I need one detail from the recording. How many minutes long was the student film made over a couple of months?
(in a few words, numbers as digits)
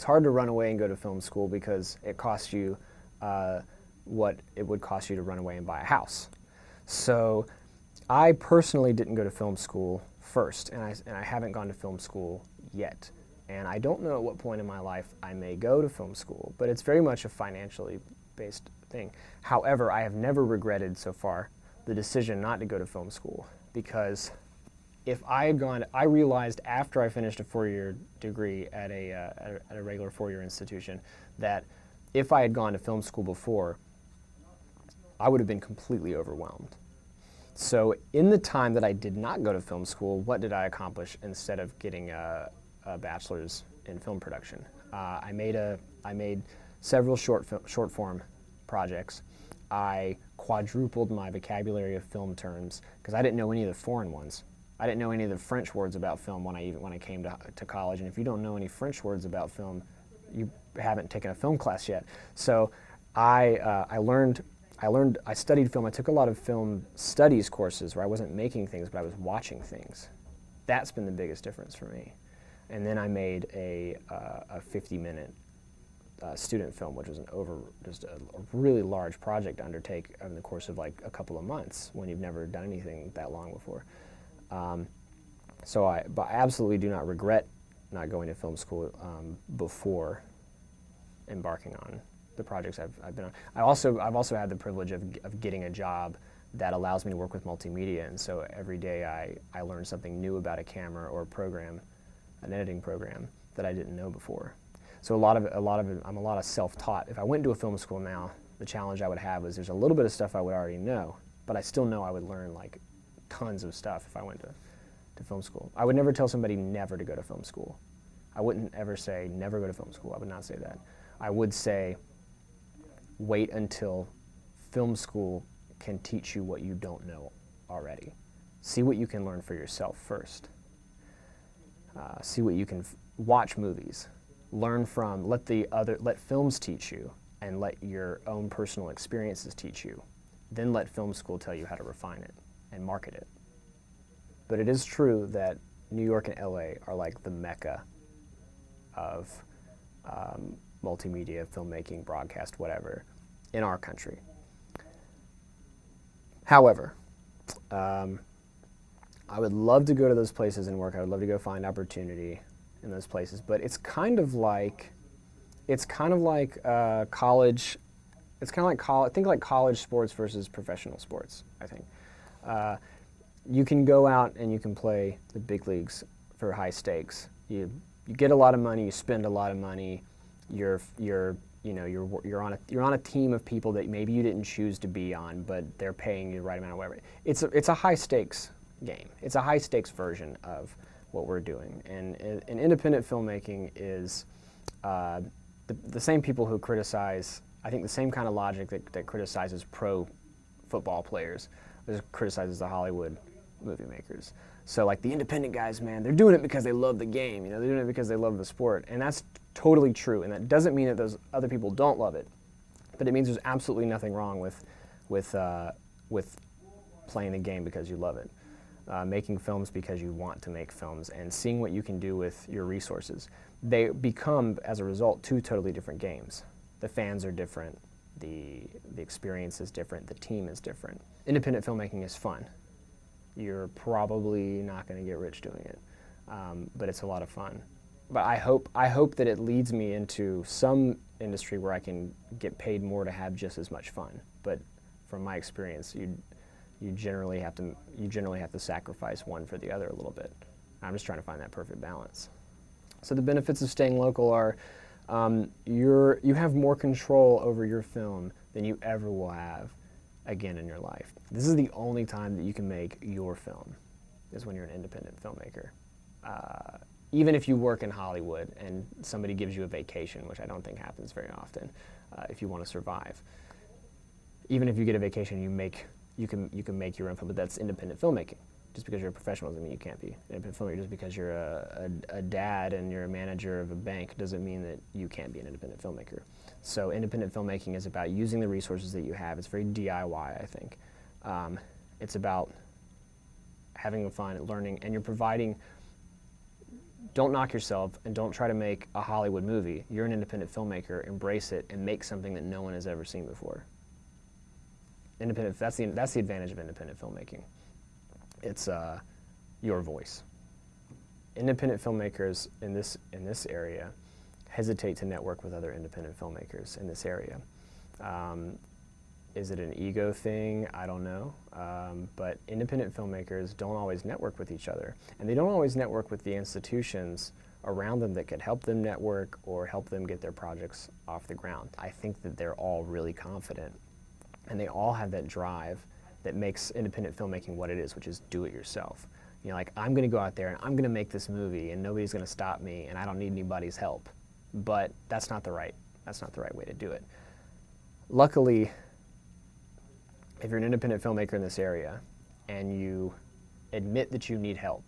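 50.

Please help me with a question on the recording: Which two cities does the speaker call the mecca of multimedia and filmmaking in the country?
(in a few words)
New York and LA.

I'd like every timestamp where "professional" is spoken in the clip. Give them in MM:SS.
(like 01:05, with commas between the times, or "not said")
02:50, 04:39.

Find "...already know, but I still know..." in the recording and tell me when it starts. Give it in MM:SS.
01:50.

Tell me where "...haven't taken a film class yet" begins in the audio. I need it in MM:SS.
01:00.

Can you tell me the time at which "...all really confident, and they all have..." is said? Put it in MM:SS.
05:32.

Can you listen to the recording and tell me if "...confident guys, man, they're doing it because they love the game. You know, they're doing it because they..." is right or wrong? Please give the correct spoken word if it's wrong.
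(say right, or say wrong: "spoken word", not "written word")
wrong: "independent", not "confident".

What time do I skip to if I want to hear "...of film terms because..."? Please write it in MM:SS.
00:51.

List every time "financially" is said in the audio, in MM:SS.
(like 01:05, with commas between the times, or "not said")
00:17.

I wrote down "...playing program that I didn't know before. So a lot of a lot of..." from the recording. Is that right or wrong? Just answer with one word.
wrong.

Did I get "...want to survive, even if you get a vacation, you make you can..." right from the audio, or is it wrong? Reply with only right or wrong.
right.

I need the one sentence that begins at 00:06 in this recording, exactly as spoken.
So I personally didn't go to film school first, and I, and I haven't gone to film school yet.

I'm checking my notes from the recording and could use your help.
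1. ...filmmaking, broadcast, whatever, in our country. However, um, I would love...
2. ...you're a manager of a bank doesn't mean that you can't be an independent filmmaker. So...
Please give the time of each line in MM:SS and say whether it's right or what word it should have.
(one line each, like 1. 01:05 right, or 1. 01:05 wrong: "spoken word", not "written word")
1. 02:31 right
2. 04:42 right.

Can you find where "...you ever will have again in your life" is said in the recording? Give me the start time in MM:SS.
04:18.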